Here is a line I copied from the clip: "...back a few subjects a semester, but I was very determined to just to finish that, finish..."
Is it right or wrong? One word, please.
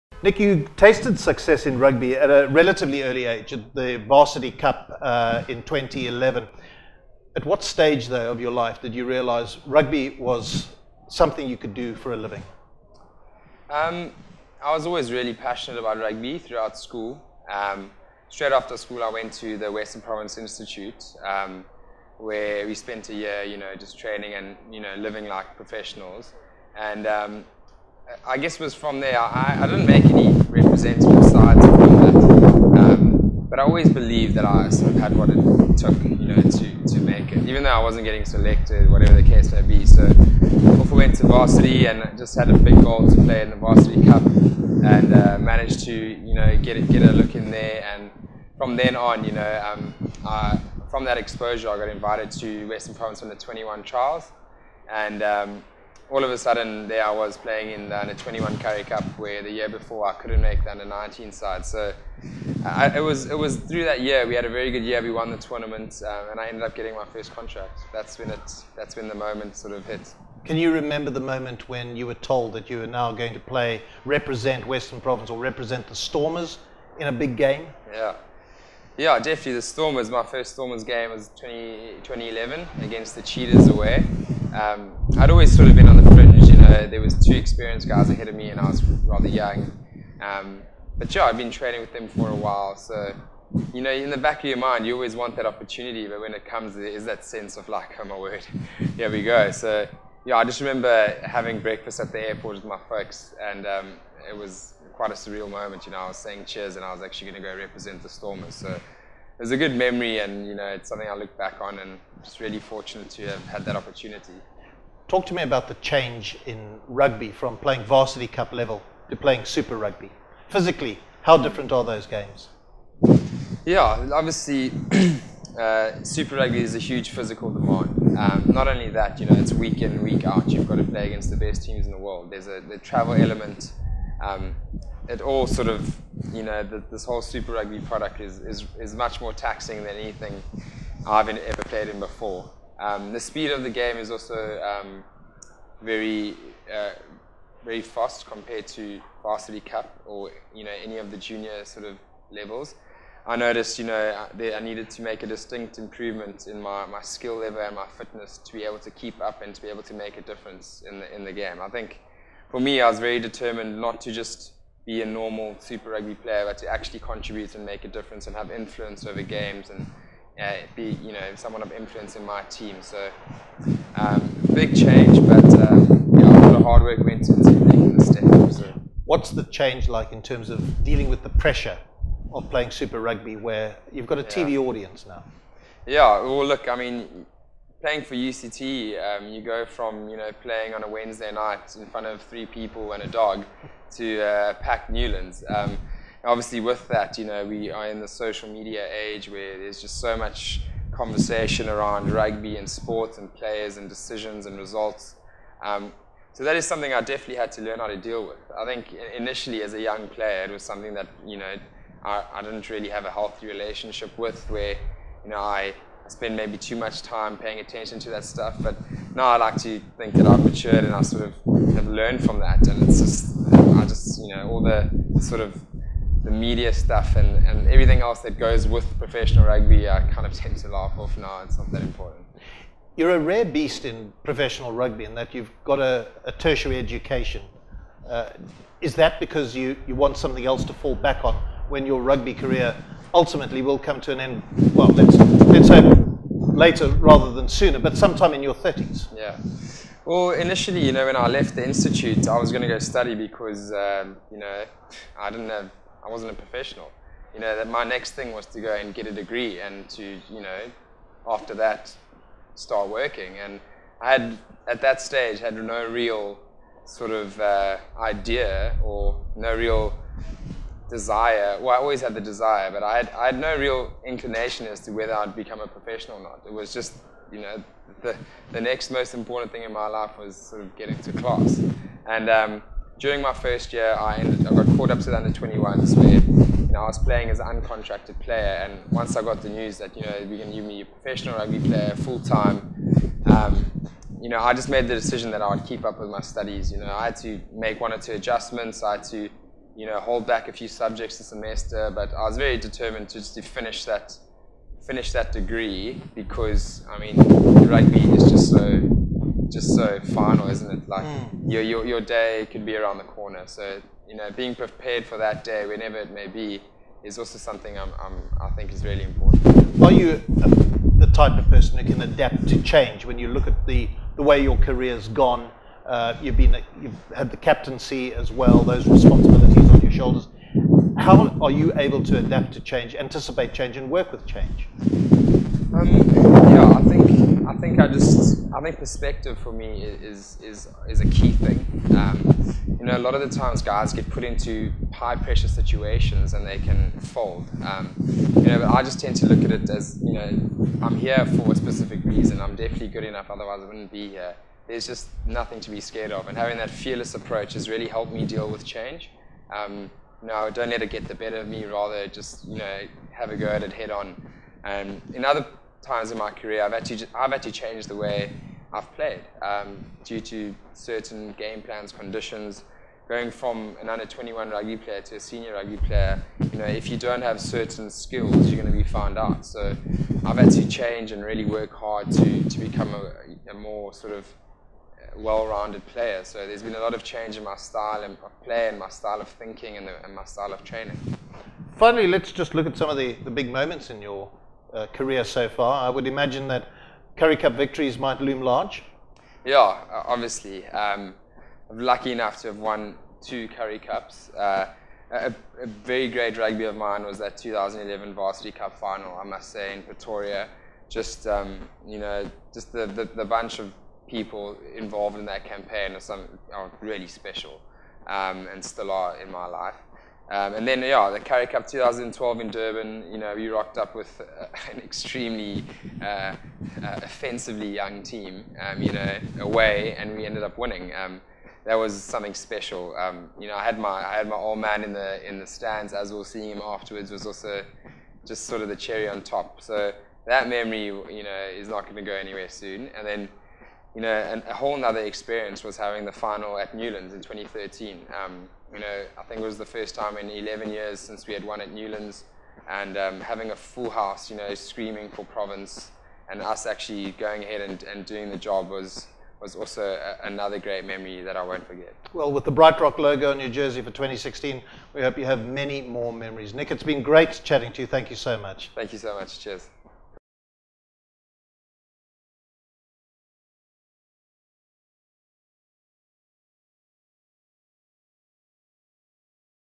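right.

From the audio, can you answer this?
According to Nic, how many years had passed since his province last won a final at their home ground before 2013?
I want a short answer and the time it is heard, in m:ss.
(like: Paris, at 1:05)
11, at 7:30.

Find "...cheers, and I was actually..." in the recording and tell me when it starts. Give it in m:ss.
1:46.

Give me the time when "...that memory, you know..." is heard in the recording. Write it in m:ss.
7:20.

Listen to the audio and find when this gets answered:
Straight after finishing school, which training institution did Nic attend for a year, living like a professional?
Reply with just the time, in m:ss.
0:19.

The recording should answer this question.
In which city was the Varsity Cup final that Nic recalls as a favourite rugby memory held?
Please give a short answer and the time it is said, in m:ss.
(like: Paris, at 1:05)
Pretoria, at 6:49.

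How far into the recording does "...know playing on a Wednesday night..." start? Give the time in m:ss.
3:10.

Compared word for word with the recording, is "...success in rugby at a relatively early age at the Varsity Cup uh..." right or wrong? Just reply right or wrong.
right.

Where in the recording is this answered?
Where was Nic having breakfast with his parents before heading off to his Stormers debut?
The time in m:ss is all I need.
1:42.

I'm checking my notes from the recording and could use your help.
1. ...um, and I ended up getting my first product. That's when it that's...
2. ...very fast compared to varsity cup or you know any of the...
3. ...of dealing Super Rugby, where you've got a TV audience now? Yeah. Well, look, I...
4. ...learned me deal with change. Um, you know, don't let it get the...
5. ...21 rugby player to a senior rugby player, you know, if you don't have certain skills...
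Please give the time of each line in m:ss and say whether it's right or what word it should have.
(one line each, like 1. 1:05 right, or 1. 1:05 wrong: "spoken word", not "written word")
1. 1:06 wrong: "contract", not "product"
2. 2:27 right
3. 3:02 wrong: "playing", not "dealing"
4. 5:57 wrong: "helped", not "learned"
5. 6:14 right.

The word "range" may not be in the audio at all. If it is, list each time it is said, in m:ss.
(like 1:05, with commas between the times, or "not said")
not said.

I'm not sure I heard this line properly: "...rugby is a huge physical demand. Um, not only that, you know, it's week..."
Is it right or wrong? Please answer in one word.
right.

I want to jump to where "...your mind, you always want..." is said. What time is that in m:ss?
1:34.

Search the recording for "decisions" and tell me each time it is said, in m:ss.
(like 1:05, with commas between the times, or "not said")
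3:23, 4:54.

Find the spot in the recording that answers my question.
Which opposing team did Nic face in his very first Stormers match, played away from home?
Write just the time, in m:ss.
1:23.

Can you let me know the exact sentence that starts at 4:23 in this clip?
And I had, at that stage, had no real sort of uh, idea or no real desire.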